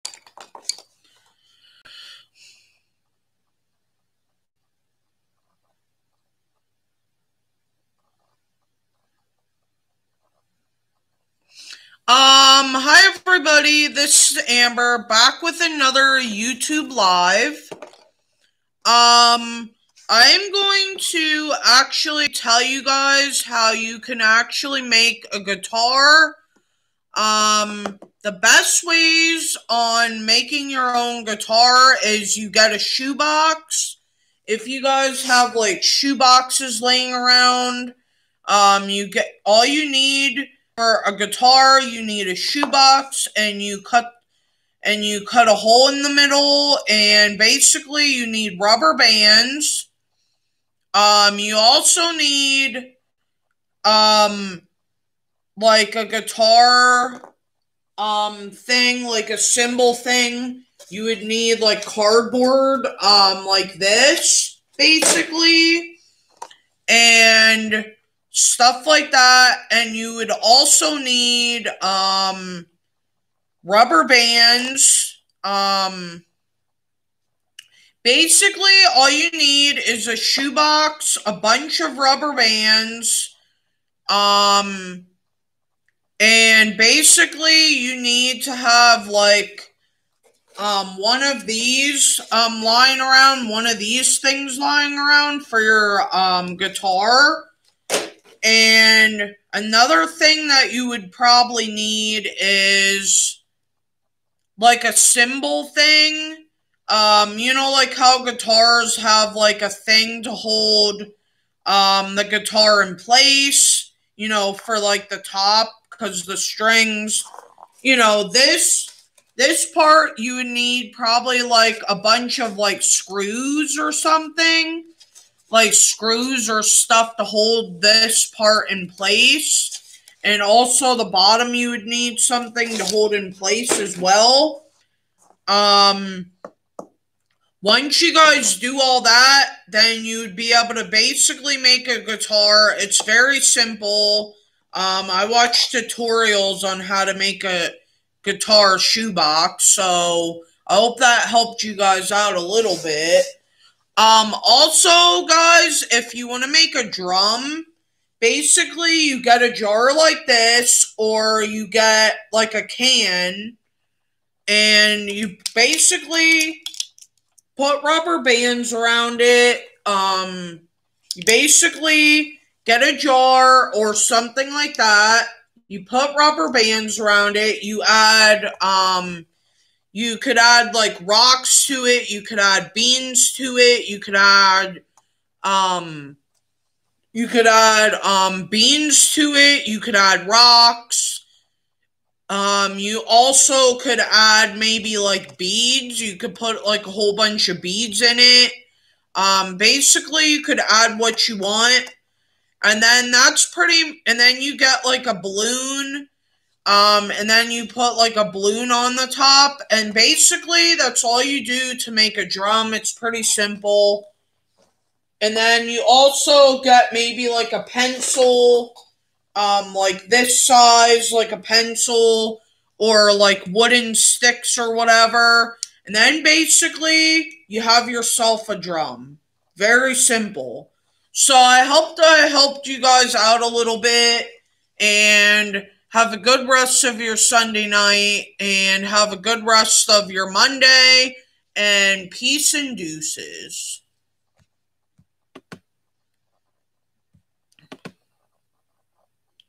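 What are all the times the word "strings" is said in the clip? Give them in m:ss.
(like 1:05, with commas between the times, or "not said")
1:56.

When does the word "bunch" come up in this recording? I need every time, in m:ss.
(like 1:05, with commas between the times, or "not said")
1:21, 2:01, 3:17.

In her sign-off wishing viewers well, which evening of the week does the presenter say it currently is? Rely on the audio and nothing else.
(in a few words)
Sunday night.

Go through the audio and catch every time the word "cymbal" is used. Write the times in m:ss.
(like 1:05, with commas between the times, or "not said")
0:59, 1:44.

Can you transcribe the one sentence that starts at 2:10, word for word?
And also the bottom you would need something to hold in place as well.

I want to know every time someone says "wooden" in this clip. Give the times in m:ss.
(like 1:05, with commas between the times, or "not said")
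3:43.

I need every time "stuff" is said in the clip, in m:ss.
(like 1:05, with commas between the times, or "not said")
1:08, 2:06.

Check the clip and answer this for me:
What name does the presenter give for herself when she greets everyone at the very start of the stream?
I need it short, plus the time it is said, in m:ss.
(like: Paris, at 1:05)
Amber, at 0:14.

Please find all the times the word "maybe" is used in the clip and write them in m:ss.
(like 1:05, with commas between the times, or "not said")
3:14, 3:36.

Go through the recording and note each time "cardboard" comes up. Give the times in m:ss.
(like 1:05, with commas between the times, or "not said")
1:01.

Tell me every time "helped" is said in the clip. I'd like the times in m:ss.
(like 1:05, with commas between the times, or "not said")
2:31, 3:52.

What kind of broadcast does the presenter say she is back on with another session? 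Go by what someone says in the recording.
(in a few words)
YouTube Live.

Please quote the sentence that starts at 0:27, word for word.
Um, the best ways on making your own guitar is you get a shoebox.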